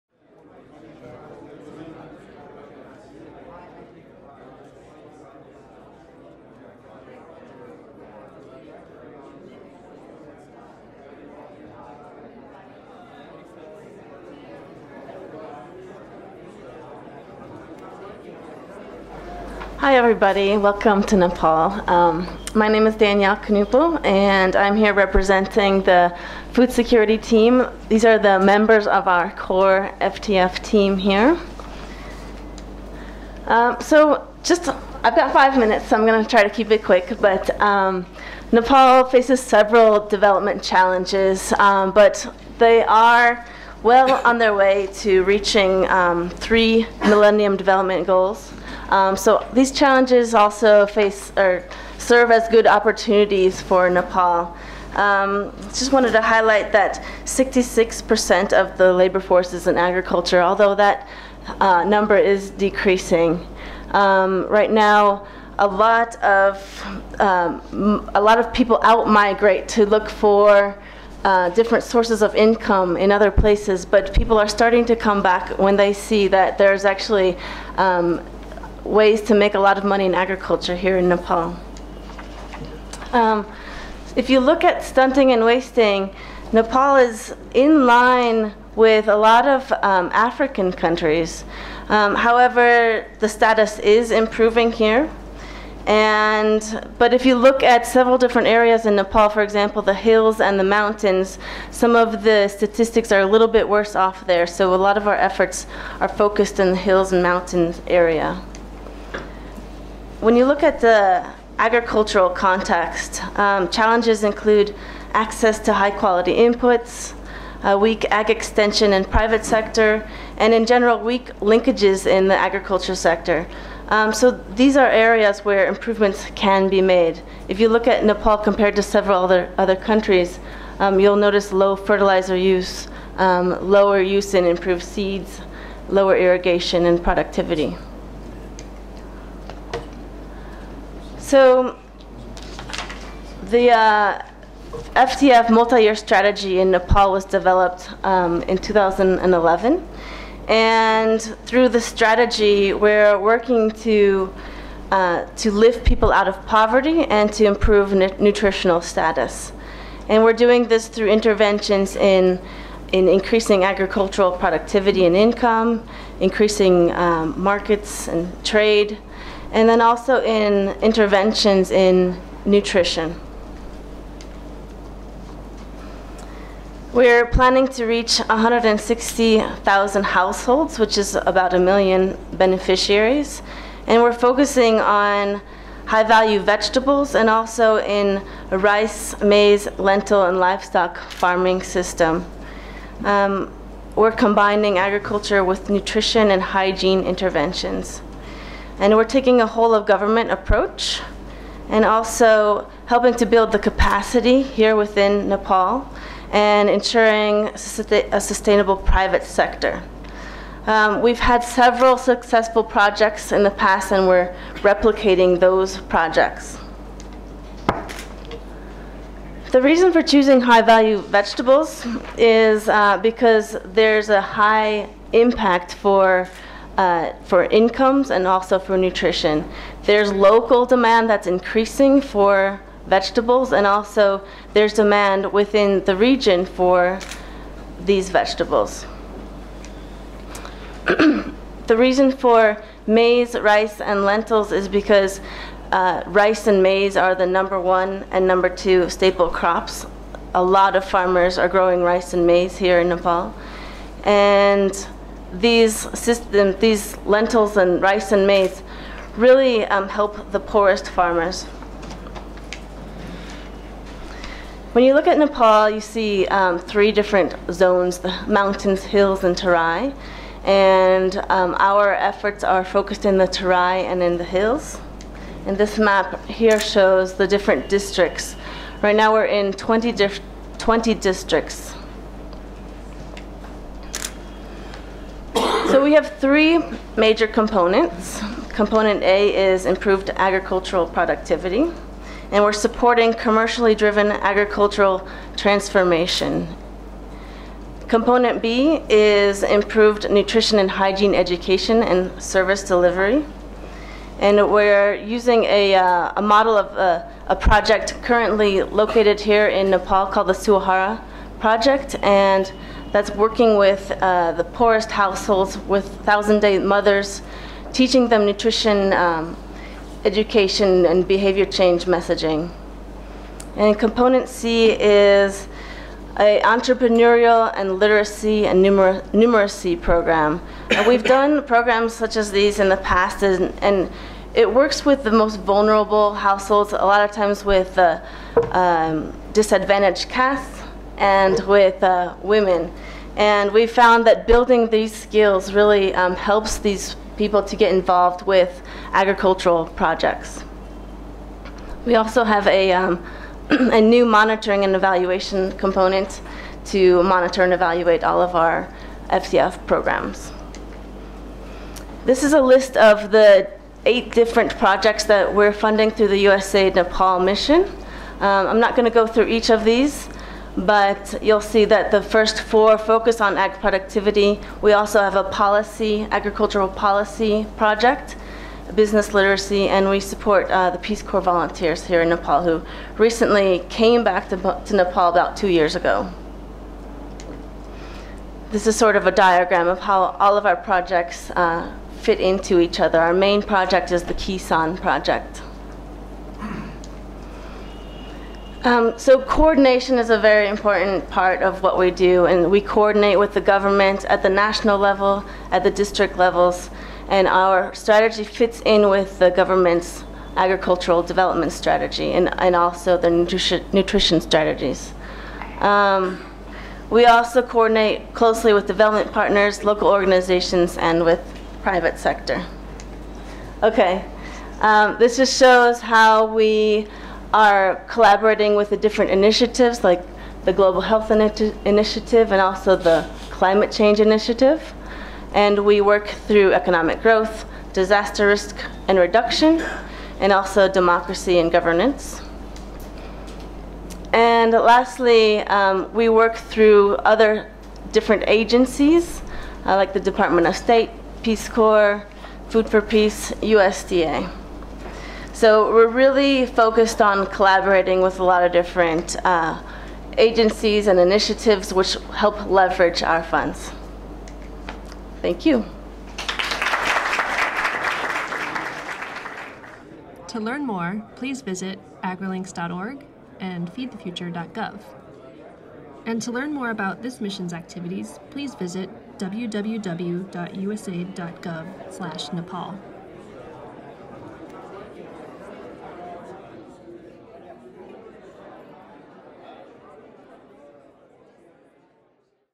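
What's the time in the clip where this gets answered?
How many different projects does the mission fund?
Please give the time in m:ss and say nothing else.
6:03.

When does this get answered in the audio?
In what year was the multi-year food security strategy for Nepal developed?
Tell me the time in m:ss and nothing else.
2:28.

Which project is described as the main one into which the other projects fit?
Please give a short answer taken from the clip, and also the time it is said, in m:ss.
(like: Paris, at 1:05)
Kisan project, at 6:34.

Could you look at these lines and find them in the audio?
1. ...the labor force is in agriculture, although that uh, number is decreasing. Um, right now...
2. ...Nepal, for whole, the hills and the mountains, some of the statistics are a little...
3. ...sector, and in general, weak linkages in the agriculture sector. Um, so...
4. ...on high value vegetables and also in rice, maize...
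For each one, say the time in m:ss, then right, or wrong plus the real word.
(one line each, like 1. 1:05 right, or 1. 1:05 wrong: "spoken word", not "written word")
1. 0:58 right
2. 1:38 wrong: "example", not "whole"
3. 1:59 right
4. 3:04 right.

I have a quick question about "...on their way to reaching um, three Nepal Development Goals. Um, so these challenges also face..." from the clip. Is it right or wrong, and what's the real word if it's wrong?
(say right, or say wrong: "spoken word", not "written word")
wrong: "Millennium", not "Nepal".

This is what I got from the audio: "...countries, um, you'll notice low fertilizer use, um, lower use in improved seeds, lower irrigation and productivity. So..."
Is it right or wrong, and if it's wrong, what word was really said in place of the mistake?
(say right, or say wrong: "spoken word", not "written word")
right.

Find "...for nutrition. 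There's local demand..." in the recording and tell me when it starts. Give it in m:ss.
3:48.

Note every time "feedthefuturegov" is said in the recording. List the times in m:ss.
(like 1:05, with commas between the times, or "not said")
7:53.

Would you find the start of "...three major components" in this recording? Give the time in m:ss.
4:46.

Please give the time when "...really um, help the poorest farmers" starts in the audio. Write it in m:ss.
4:19.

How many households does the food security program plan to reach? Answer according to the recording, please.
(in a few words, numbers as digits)
160,000.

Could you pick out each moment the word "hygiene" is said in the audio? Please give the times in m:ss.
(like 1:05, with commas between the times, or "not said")
3:16, 5:00.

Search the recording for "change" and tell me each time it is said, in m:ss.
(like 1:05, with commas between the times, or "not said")
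5:21, 7:13.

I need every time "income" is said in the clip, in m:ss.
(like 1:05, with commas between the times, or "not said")
1:12, 2:45, 3:47.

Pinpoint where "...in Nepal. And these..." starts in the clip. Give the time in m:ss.
4:12.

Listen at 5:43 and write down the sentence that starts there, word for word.
And we found that building these skills really um, helps these people to get involved with agricultural projects.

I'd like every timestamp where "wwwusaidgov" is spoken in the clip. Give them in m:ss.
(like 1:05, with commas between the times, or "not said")
7:59.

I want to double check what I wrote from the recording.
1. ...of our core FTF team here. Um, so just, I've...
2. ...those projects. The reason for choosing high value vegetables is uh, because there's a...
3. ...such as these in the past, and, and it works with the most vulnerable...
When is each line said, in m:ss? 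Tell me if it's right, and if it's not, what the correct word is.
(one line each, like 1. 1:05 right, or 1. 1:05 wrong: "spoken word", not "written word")
1. 0:28 right
2. 3:35 right
3. 5:31 right.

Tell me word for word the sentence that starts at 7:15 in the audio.
And we work through economic growth, disaster risk and reduction, and also democracy and governance.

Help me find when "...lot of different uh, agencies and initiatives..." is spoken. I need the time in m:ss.
7:38.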